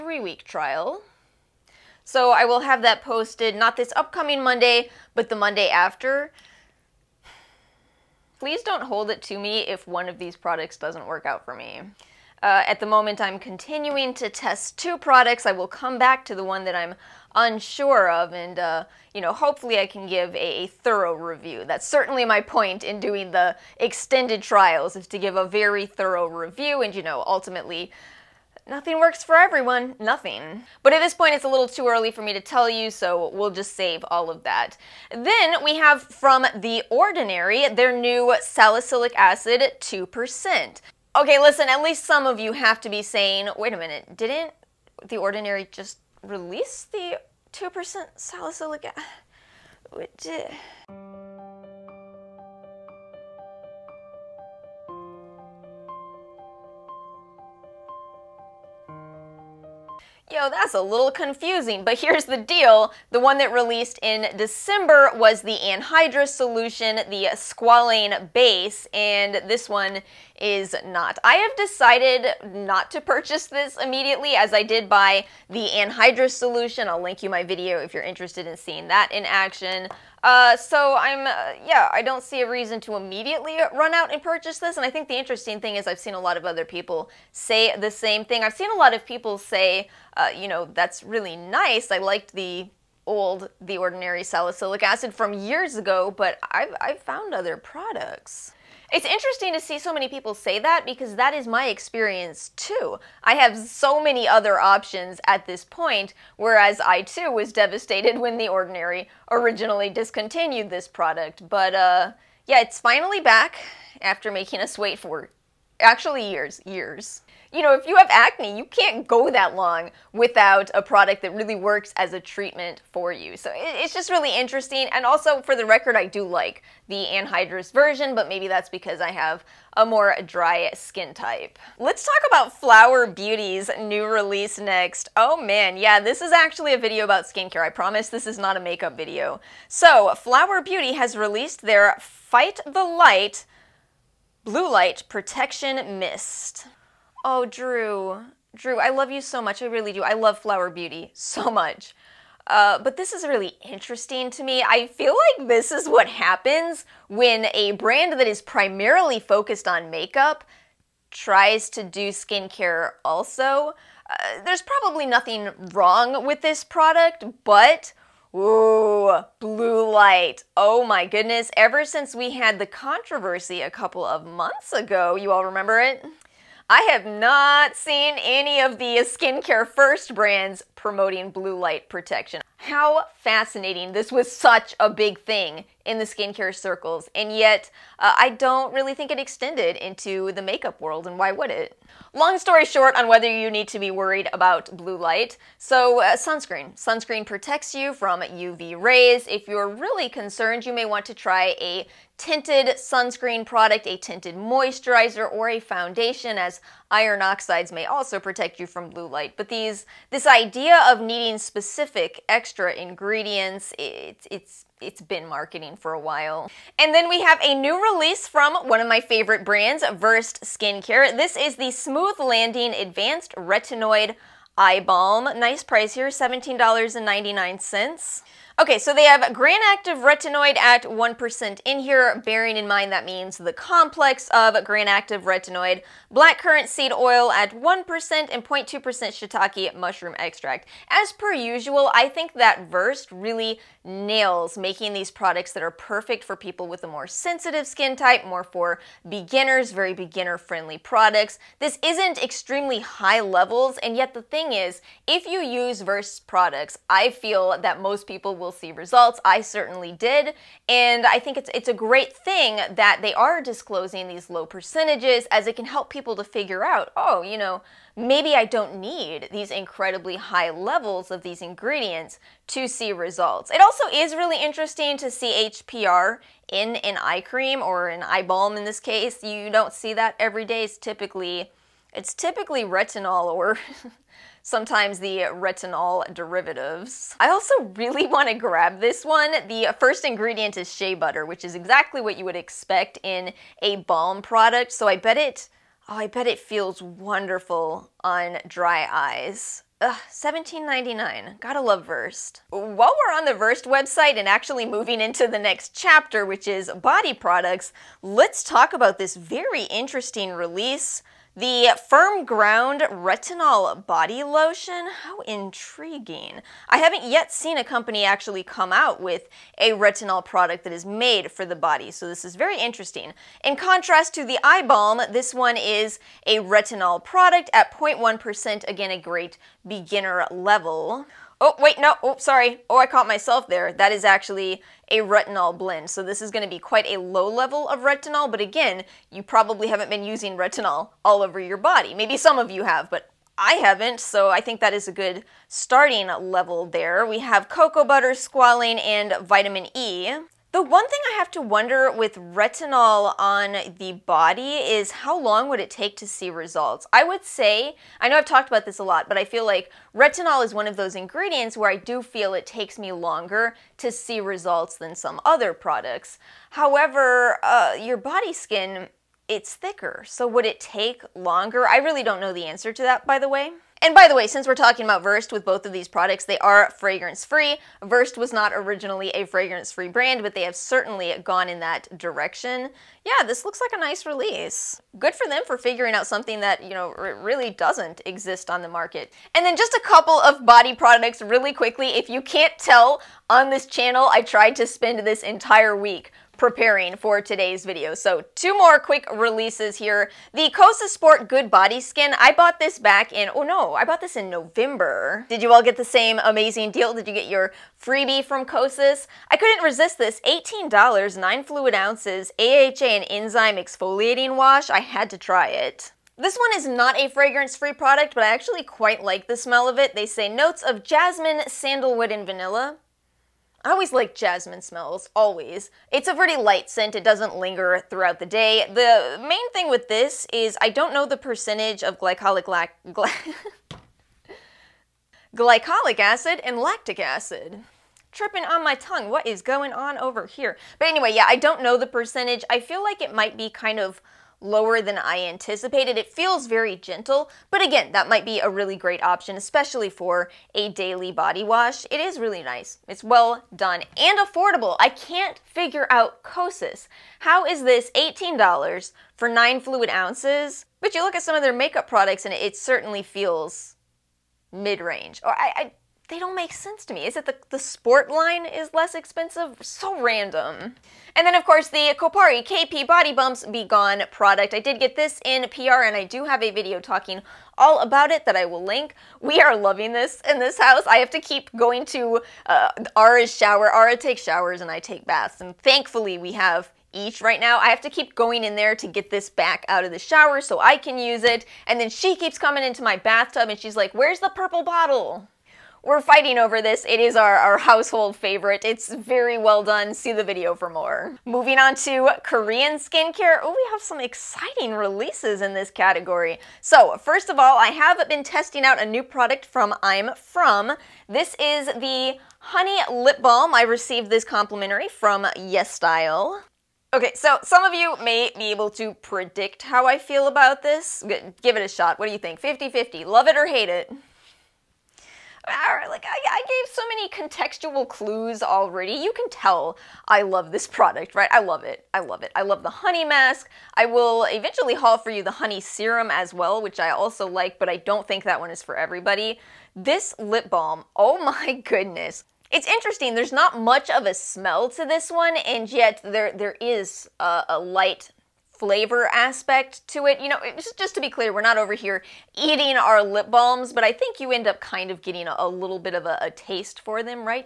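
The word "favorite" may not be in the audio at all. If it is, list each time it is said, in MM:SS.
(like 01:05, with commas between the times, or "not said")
03:39, 08:18.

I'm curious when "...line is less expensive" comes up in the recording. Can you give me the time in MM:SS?
07:48.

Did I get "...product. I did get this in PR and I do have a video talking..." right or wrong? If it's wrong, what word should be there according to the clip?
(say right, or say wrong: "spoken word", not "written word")
right.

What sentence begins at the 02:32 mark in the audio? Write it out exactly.
Uh, but this is really interesting to me.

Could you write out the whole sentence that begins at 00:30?
But at this point, it's a little too early for me to tell you, so we'll just save all of that.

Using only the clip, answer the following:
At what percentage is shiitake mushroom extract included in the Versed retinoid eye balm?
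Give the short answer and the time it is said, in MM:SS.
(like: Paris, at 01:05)
0.2%, at 03:58.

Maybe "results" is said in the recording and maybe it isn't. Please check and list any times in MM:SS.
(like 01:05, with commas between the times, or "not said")
04:18, 04:32, 05:56, 06:04.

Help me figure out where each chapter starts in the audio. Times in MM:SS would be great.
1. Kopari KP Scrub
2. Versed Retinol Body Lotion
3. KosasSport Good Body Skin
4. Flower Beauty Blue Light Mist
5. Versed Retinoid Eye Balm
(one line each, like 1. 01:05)
1. 07:52
2. 05:04
3. 06:40
4. 02:13
5. 03:37.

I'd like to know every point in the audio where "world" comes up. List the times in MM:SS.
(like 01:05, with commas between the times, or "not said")
03:10.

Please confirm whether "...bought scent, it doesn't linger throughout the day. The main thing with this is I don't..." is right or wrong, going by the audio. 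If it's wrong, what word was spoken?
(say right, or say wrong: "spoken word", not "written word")
wrong: "light", not "bought".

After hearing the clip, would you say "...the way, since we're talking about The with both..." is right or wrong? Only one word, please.
wrong.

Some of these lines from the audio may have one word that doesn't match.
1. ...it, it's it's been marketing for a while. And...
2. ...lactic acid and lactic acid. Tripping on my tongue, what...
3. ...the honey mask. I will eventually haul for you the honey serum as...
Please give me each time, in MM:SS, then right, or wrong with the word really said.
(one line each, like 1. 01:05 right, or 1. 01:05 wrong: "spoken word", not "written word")
1. 03:33 right
2. 07:15 wrong: "glycolic", not "lactic"
3. 08:52 right.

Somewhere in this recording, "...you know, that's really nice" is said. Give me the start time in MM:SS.
01:30.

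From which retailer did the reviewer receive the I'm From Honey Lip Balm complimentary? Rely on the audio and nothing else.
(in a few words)
Yes Style.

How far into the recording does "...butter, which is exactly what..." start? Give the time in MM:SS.
04:50.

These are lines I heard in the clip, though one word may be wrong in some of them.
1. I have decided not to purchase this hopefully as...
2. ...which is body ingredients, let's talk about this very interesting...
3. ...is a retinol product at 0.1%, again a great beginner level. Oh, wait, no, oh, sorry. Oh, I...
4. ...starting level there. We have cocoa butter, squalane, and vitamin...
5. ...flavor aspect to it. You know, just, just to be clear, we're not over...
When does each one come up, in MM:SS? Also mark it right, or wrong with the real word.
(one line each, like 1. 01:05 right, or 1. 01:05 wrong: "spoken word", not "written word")
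1. 01:11 wrong: "immediately", not "hopefully"
2. 05:06 wrong: "products", not "ingredients"
3. 05:25 right
4. 05:45 right
5. 09:08 right.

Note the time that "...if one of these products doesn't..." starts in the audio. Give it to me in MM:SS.
00:09.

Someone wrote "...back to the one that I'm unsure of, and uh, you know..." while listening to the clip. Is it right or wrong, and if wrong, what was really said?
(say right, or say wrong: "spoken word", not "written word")
right.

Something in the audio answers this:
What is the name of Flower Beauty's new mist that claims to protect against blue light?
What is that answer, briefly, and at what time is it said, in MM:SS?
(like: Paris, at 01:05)
Fight the Light, at 02:21.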